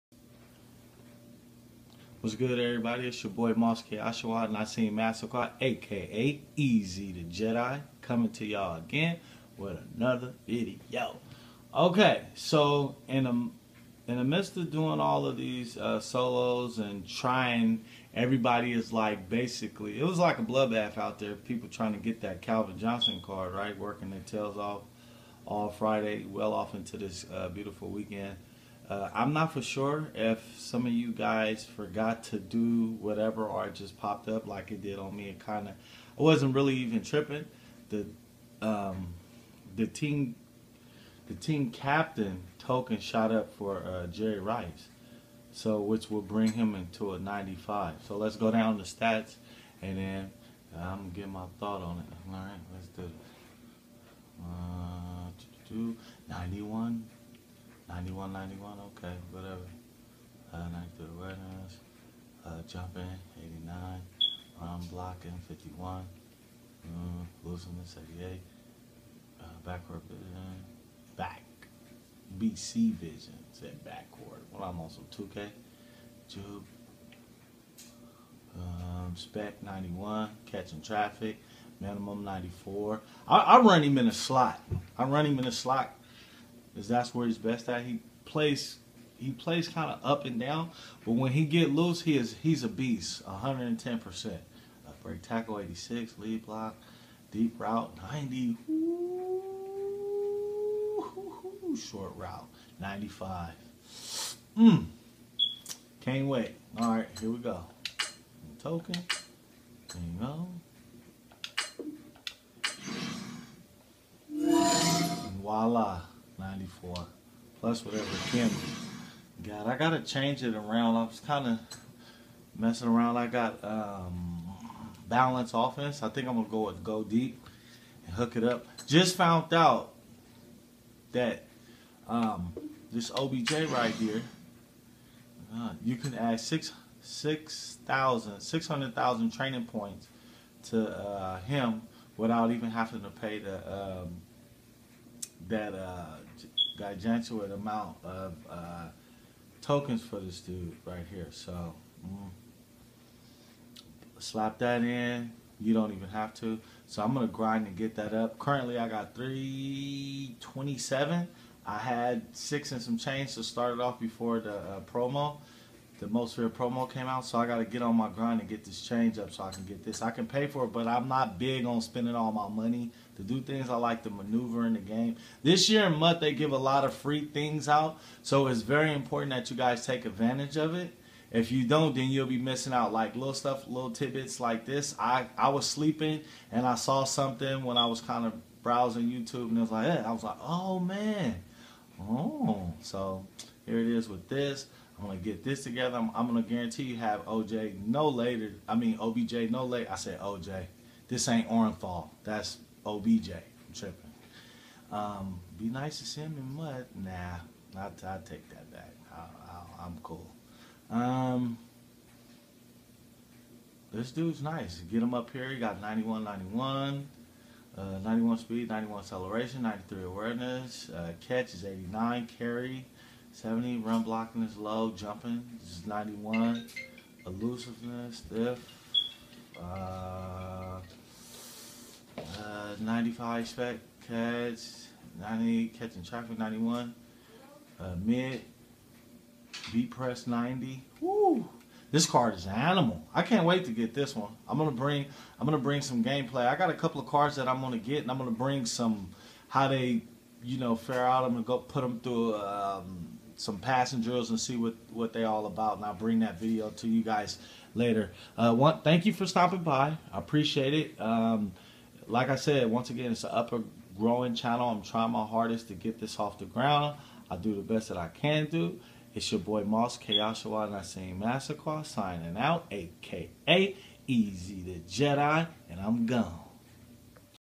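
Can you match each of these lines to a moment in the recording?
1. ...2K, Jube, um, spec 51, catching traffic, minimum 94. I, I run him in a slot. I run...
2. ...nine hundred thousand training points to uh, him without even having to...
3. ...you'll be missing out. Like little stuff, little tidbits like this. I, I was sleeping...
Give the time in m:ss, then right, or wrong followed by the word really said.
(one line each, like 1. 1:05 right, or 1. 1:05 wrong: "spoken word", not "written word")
1. 1:15 wrong: "91", not "51"
2. 2:18 wrong: "six", not "nine"
3. 3:02 right.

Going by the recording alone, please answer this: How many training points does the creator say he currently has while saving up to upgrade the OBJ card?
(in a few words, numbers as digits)
327.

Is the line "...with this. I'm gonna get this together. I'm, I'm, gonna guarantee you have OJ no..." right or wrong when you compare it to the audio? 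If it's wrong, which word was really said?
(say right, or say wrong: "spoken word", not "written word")
right.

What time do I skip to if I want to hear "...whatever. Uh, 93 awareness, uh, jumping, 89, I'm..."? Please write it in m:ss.
0:59.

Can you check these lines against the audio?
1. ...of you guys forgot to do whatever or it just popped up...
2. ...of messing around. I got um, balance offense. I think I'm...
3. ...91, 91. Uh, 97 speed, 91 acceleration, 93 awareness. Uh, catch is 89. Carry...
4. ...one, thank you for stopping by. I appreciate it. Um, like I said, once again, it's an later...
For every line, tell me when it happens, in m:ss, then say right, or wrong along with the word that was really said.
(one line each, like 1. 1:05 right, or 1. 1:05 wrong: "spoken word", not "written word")
1. 0:30 right
2. 2:01 right
3. 3:35 wrong: "91", not "97"
4. 4:18 wrong: "upper", not "later".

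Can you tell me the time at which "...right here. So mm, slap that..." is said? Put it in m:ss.
2:30.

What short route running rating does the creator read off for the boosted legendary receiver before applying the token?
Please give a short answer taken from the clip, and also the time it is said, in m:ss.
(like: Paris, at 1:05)
95, at 1:41.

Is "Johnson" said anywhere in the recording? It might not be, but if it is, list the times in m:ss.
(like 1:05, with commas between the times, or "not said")
0:22.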